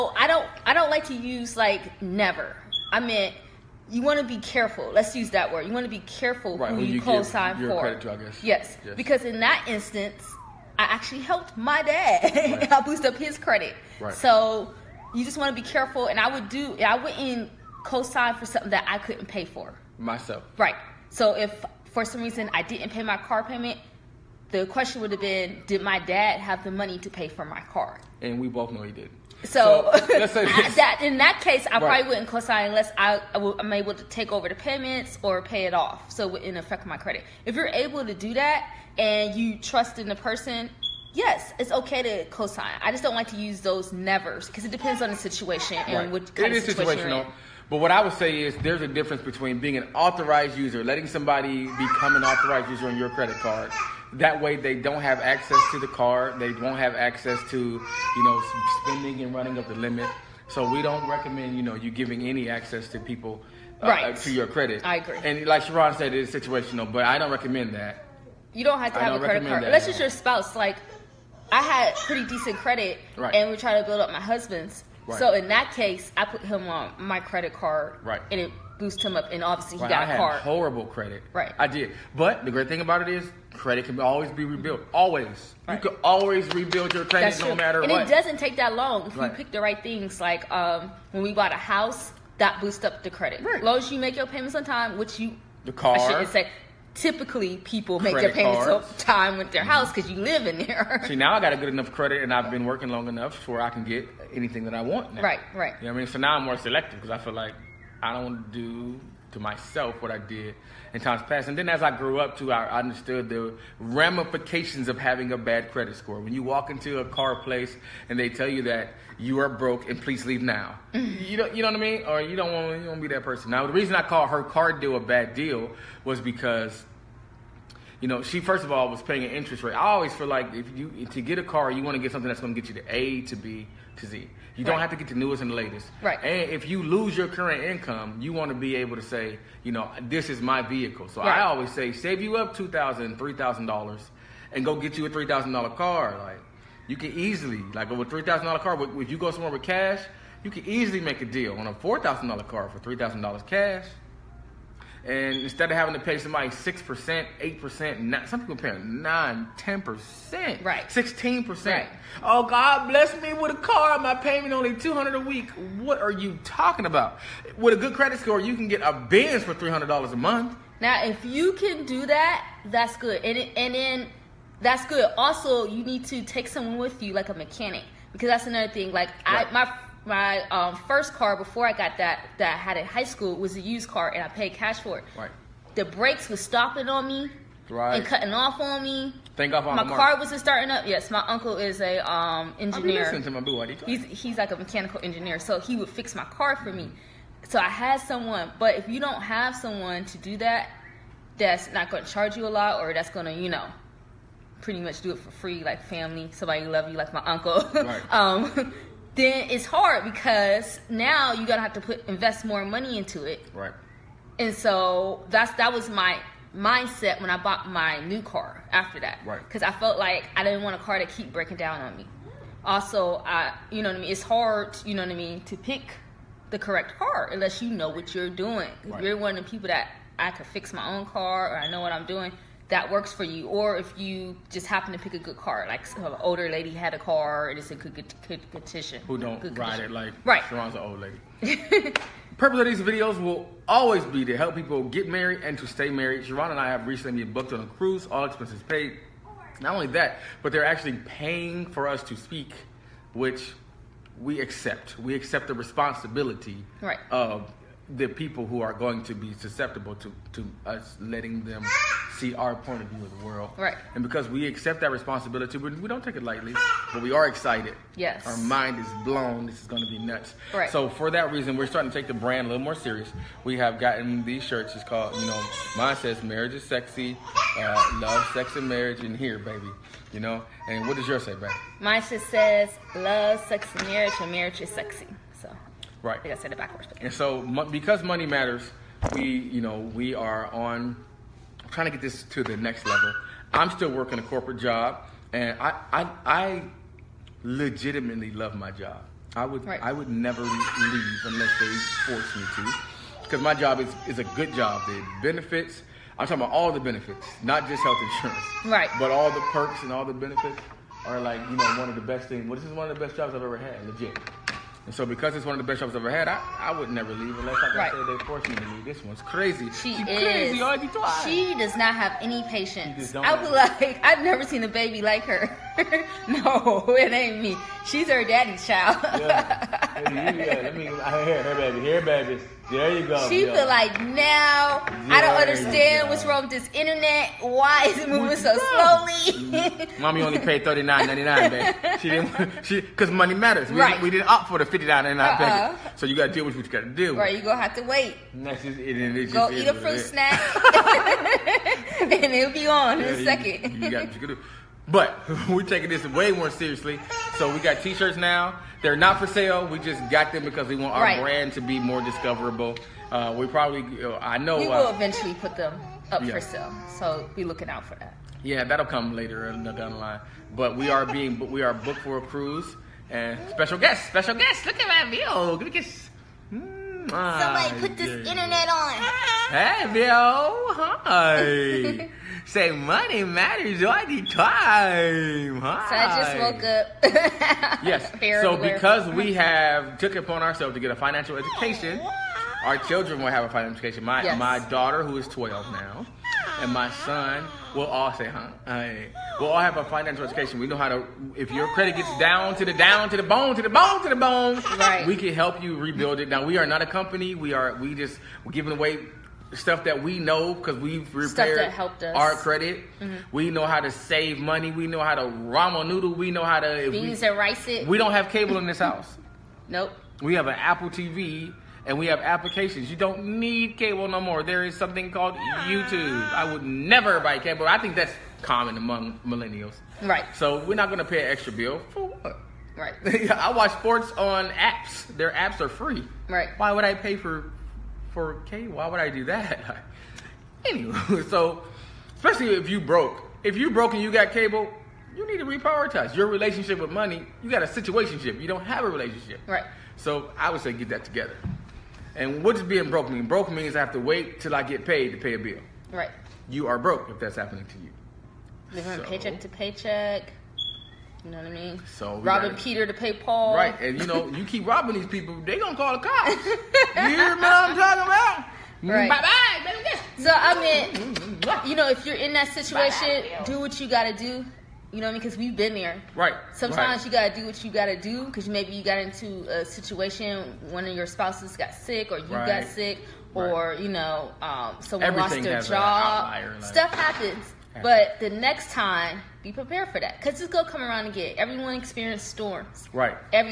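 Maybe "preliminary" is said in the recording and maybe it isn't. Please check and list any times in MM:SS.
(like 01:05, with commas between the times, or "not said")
not said.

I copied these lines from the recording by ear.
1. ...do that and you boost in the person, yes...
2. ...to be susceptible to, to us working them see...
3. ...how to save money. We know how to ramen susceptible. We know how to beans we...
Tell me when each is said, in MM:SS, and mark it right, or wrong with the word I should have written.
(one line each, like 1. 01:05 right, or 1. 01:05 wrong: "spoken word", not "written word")
1. 00:38 wrong: "trust", not "boost"
2. 04:19 wrong: "letting", not "working"
3. 06:53 wrong: "noodle", not "susceptible".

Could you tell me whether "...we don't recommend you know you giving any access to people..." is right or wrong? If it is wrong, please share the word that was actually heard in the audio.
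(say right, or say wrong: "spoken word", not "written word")
right.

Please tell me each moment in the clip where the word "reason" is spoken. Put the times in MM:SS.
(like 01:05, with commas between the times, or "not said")
00:22, 02:03, 04:31.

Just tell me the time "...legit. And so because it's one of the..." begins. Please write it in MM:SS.
05:13.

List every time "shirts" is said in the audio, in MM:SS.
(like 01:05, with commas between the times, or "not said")
04:34, 05:57.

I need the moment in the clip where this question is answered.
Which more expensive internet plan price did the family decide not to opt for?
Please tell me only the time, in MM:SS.
05:44.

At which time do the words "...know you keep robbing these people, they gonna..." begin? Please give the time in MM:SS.
07:44.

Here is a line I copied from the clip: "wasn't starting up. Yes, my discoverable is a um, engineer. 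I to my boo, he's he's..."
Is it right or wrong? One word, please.
wrong.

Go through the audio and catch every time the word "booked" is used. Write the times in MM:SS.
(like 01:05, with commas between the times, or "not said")
04:07, 06:11.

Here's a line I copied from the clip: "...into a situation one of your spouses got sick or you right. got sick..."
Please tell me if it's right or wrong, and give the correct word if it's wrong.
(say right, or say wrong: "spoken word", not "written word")
right.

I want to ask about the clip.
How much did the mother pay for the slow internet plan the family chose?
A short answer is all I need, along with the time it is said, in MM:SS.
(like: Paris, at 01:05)
$39.99, at 05:40.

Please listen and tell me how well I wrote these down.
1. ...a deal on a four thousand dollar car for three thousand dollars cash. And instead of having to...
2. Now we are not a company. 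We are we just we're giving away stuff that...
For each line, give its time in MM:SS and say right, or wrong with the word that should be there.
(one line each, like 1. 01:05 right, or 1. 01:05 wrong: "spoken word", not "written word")
1. 02:31 right
2. 06:46 right.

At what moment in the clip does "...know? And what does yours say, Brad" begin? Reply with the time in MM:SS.
04:40.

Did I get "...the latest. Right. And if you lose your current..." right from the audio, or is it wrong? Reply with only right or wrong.
right.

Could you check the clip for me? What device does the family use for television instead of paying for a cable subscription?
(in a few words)
Apple TV.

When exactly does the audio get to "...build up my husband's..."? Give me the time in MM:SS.
01:13.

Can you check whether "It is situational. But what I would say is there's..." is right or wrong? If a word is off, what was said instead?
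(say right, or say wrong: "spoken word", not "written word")
right.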